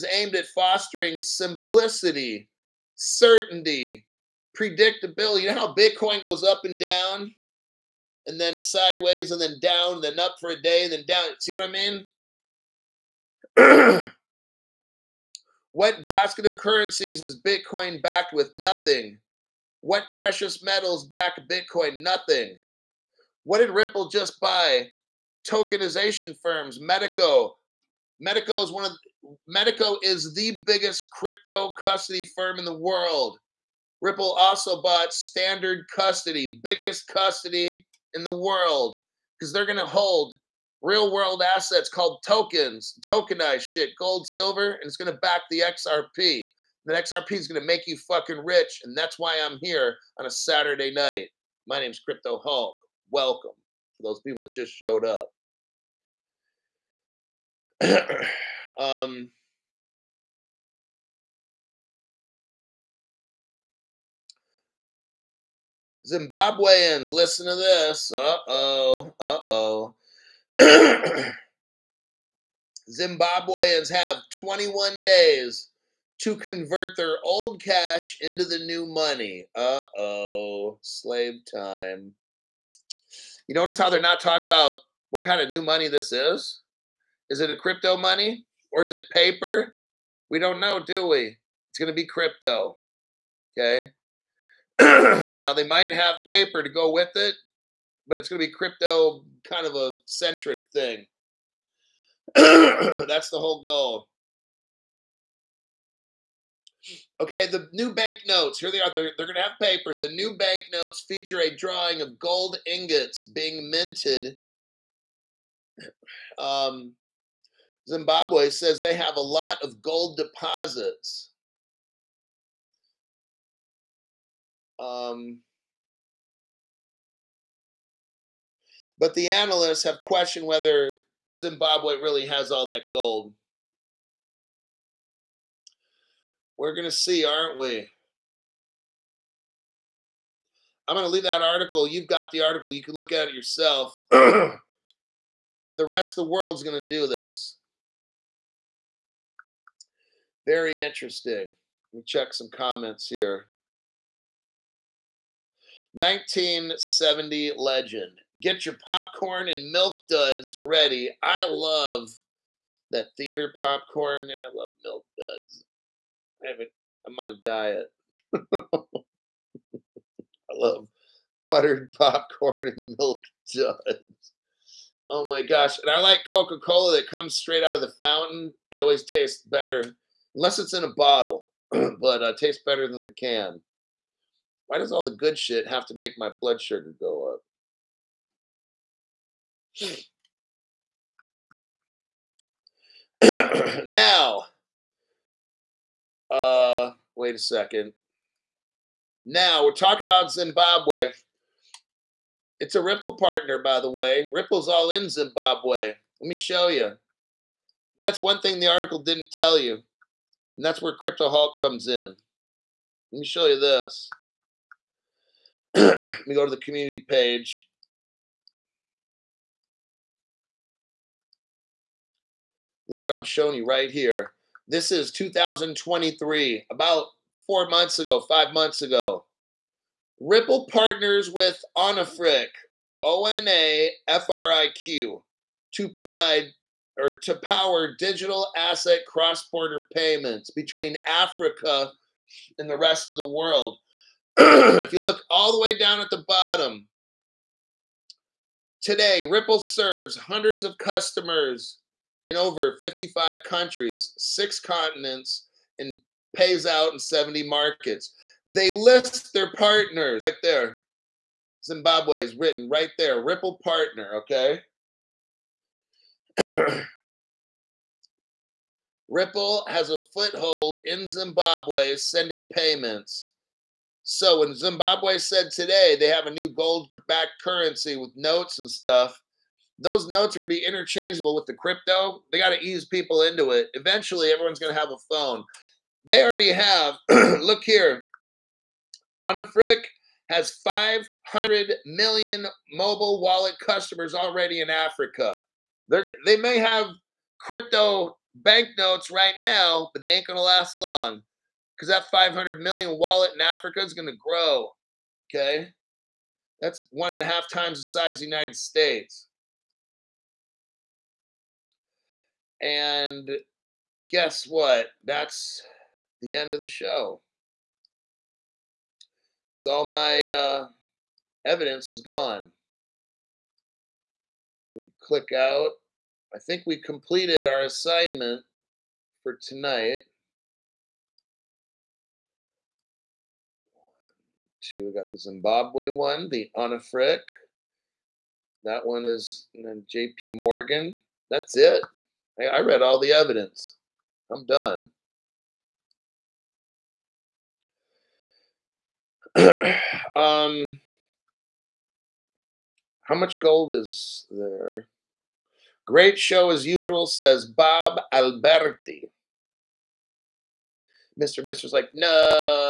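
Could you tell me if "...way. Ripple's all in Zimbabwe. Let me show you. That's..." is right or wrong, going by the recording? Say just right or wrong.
right.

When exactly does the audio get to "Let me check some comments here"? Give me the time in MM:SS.
02:31.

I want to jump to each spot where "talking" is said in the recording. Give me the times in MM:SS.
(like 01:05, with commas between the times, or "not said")
01:24, 03:19.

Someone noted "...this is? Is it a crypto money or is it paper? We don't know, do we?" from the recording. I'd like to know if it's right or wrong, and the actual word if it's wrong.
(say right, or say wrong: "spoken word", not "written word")
right.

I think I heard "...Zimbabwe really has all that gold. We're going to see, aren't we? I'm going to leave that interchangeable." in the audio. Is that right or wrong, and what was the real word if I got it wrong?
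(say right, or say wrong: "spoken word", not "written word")
wrong: "article", not "interchangeable".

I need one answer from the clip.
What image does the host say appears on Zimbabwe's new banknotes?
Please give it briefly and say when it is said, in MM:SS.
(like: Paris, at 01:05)
Gold ingots being minted, at 01:52.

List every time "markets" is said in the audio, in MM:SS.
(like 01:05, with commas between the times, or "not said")
04:17.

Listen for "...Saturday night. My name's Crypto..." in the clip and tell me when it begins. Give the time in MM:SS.
00:50.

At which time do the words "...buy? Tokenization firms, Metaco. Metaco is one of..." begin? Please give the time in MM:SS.
00:24.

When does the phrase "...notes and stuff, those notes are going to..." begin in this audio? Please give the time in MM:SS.
04:38.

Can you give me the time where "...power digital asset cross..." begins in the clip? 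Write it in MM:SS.
03:57.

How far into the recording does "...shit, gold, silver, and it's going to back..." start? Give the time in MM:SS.
00:43.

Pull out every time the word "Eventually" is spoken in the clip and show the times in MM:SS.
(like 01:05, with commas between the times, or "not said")
04:43.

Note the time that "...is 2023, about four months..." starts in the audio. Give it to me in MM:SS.
03:44.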